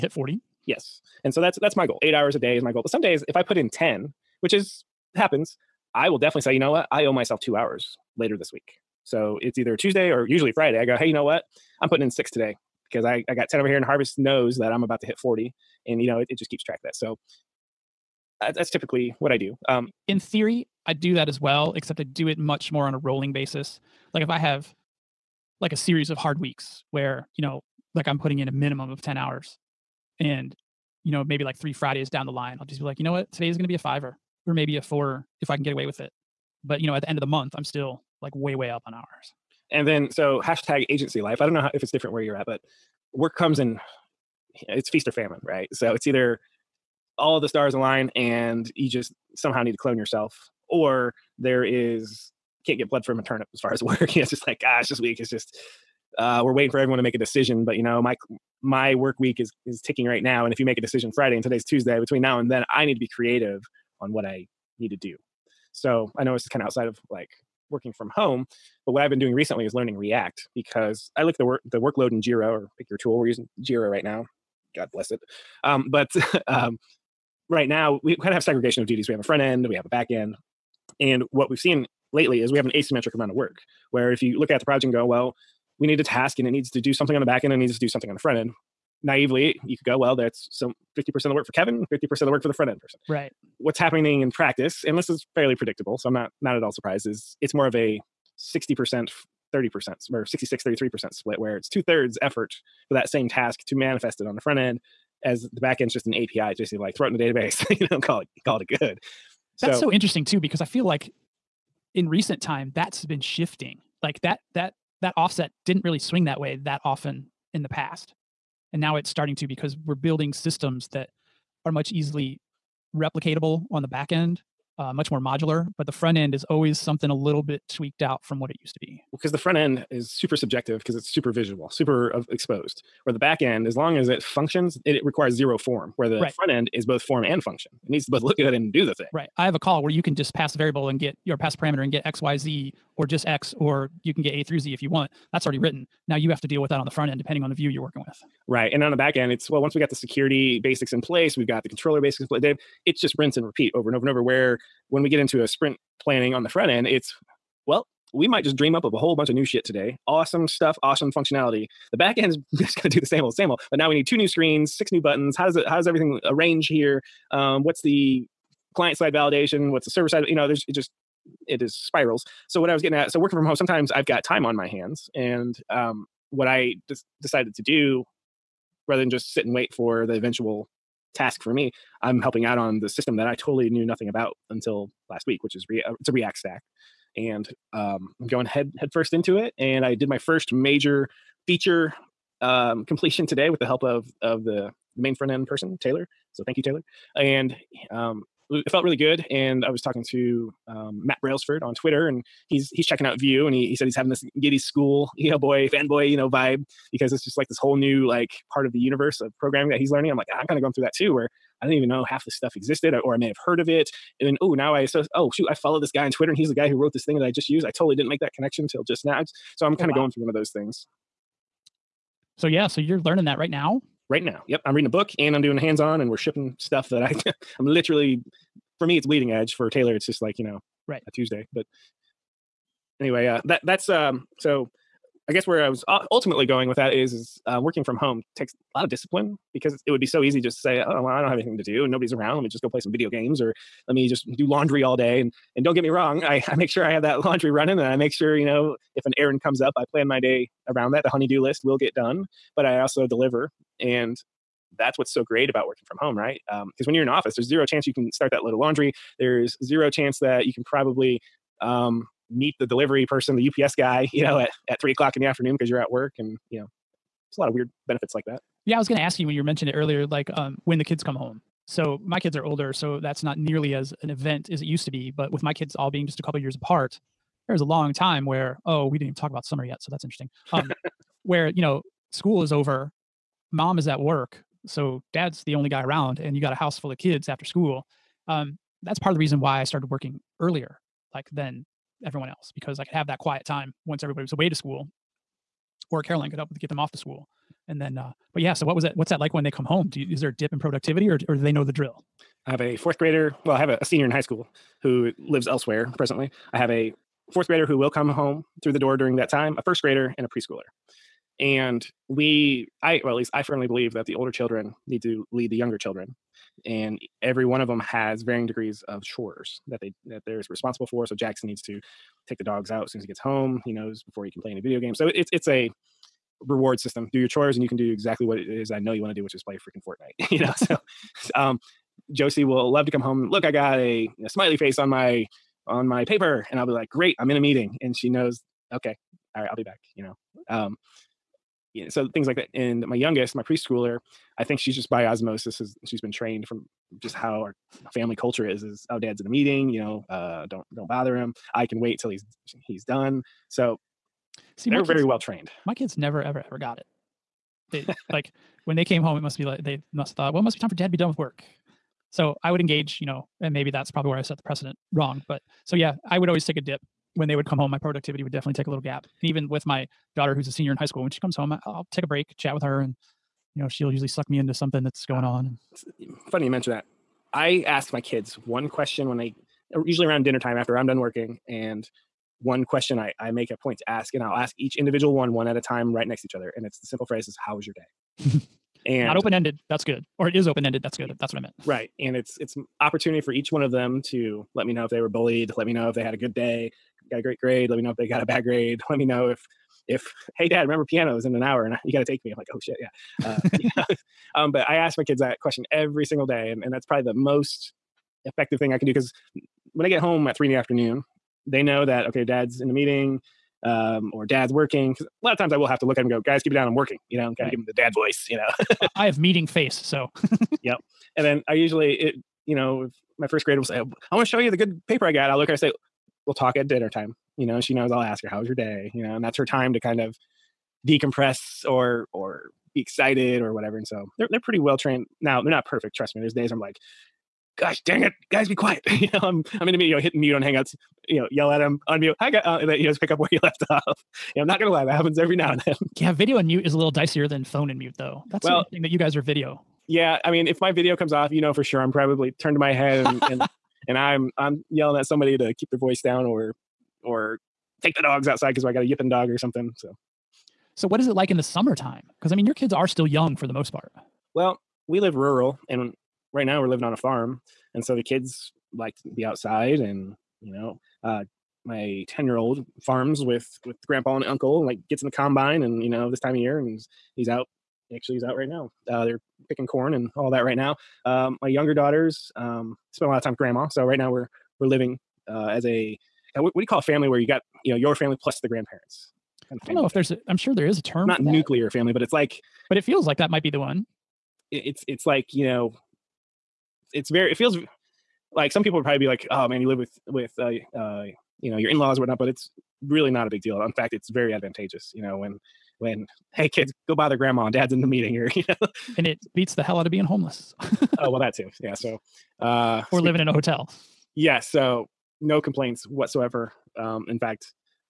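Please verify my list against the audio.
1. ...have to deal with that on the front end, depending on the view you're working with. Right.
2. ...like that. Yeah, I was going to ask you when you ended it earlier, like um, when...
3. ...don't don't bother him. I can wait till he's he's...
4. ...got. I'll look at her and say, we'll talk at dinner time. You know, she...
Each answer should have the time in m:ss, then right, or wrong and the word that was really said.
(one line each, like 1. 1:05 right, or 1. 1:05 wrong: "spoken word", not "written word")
1. 2:26 right
2. 4:28 wrong: "mentioned", not "ended"
3. 5:50 right
4. 7:05 right.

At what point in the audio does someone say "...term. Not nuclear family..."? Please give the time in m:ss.
8:10.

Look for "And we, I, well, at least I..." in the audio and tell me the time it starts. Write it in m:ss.
5:11.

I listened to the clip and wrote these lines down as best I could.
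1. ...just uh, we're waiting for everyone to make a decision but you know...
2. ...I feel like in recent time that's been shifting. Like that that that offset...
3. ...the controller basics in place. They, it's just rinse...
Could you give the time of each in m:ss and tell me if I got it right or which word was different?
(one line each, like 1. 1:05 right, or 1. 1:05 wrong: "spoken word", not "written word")
1. 0:55 right
2. 1:50 right
3. 2:31 right.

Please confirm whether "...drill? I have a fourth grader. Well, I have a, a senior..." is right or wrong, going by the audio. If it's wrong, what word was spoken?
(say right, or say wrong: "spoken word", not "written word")
right.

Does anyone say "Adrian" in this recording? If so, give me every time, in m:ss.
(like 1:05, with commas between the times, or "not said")
not said.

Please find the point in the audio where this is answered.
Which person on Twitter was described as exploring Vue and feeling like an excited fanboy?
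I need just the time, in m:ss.
3:21.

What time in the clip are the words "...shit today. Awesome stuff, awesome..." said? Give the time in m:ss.
2:39.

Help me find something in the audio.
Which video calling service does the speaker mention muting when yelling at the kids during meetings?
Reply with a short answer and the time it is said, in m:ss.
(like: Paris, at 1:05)
Hangouts, at 7:20.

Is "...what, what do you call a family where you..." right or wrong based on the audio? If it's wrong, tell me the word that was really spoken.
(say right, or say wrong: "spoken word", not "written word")
right.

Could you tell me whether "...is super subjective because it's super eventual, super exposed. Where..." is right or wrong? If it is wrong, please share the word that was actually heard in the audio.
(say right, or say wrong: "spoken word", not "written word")
wrong: "visual", not "eventual".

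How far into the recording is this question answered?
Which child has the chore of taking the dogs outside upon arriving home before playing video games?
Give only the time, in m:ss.
5:21.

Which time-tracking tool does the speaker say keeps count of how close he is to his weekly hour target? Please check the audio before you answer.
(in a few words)
Harvest.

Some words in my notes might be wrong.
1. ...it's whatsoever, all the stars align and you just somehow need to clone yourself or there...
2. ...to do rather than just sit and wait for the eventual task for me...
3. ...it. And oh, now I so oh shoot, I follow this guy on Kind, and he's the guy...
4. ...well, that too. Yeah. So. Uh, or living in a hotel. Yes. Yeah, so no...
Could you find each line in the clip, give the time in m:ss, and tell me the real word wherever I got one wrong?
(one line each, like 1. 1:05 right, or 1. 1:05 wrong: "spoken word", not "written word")
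1. 0:45 wrong: "either", not "whatsoever"
2. 2:57 right
3. 3:33 wrong: "Twitter", not "Kind"
4. 8:31 right.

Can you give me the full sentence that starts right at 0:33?
Today is going to be a fiver or maybe a four if I can get away with it.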